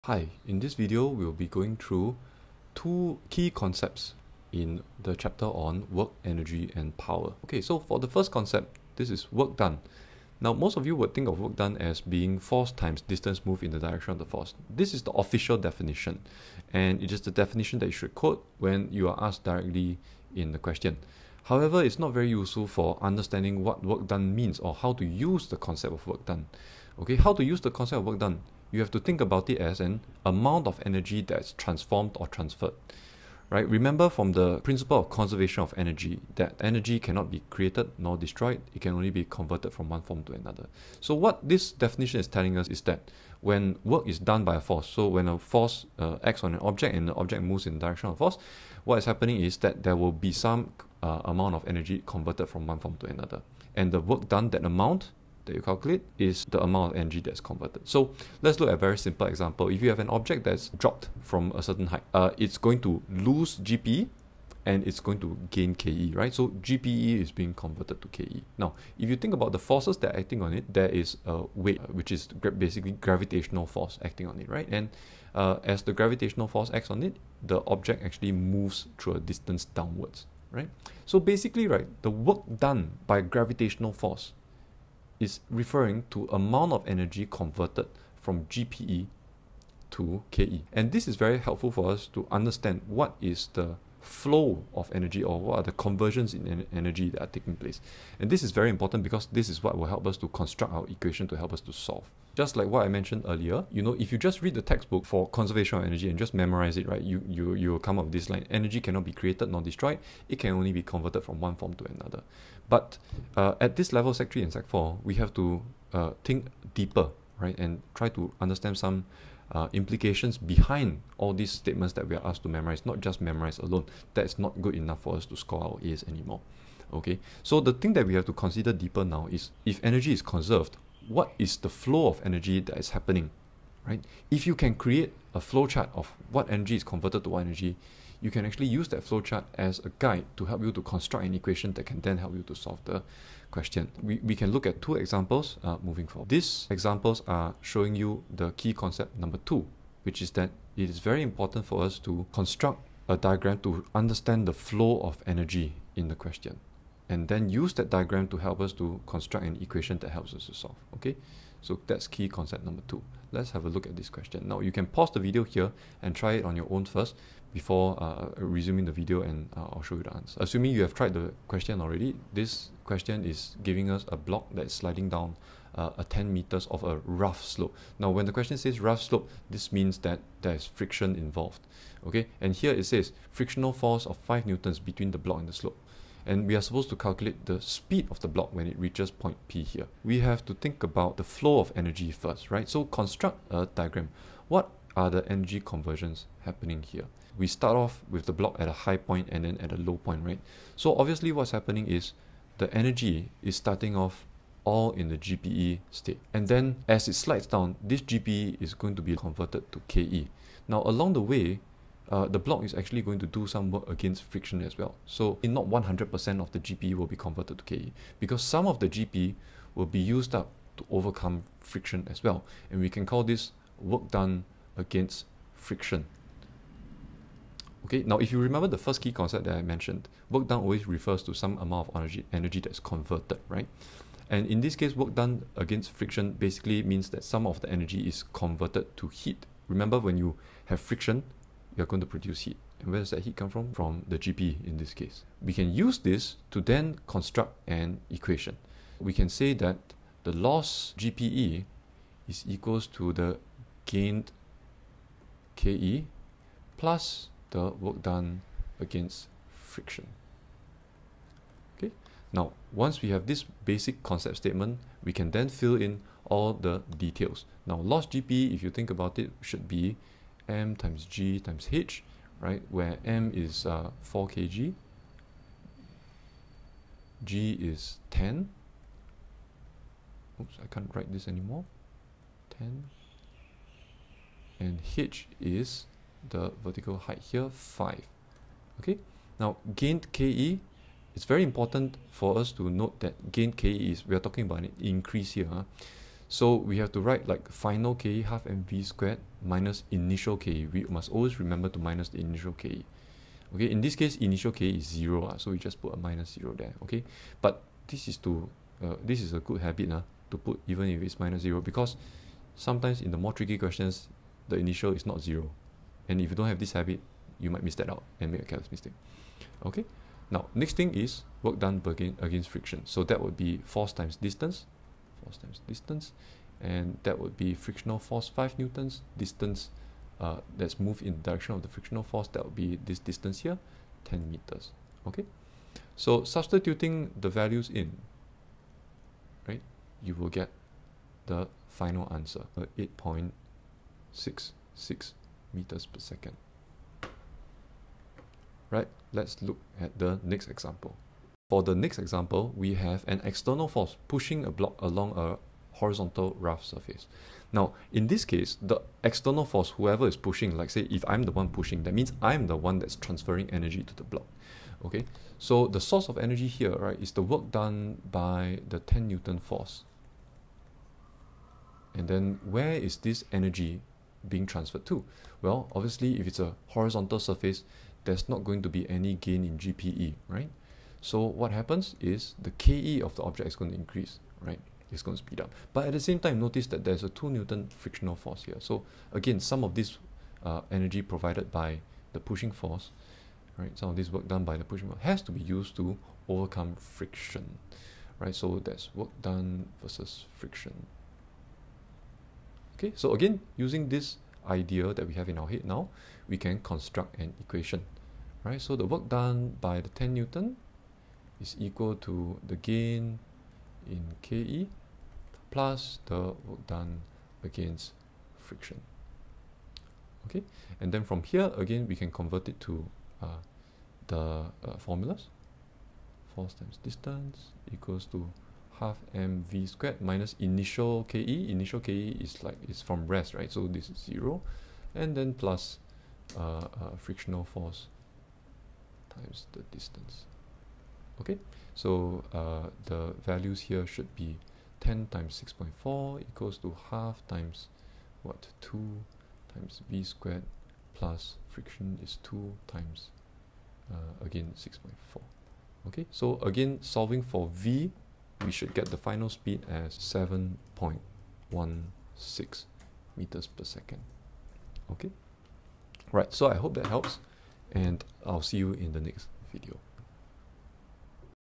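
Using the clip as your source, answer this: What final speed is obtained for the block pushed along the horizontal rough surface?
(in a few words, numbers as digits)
7.16 meters per second.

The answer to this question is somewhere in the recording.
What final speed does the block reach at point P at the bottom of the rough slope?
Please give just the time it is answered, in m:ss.
5:42.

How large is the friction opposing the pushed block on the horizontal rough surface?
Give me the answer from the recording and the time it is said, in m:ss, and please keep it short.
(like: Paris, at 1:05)
2 Newton, at 6:27.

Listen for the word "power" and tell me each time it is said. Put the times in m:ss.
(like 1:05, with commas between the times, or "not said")
0:06.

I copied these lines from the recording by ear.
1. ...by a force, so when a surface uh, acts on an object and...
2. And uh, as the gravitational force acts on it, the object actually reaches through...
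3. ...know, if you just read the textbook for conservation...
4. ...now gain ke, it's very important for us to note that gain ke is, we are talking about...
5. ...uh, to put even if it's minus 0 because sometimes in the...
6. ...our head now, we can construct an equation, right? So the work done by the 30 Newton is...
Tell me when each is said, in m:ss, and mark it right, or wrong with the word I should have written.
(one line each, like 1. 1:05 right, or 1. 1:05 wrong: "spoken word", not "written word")
1. 0:44 wrong: "force", not "surface"
2. 1:14 wrong: "moves", not "reaches"
3. 1:43 right
4. 4:49 right
5. 5:09 right
6. 6:45 wrong: "10", not "30".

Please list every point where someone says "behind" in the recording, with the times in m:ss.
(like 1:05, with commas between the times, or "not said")
2:00.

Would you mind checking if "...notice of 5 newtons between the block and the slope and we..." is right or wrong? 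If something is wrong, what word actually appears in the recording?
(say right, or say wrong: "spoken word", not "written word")
wrong: "force", not "notice".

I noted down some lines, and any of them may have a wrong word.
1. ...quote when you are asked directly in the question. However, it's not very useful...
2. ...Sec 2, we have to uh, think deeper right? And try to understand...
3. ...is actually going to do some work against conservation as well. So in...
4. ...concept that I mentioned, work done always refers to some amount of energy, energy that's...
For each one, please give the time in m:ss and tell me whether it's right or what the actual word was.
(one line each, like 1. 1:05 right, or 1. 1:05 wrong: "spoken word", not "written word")
1. 0:18 right
2. 1:54 wrong: "4", not "2"
3. 3:32 wrong: "friction", not "conservation"
4. 3:49 right.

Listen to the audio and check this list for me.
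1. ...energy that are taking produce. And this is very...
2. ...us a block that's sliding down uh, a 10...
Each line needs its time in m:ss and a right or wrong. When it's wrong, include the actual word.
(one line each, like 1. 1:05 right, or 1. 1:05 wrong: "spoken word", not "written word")
1. 1:36 wrong: "place", not "produce"
2. 2:53 right.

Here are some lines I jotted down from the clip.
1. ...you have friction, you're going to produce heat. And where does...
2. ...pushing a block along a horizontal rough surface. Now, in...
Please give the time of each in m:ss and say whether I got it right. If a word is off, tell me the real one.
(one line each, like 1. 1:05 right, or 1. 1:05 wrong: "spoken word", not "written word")
1. 4:00 right
2. 5:54 right.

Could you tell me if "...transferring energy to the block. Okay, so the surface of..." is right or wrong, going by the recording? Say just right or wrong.
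wrong.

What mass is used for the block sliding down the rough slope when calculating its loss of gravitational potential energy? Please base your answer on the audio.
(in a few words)
4 kg.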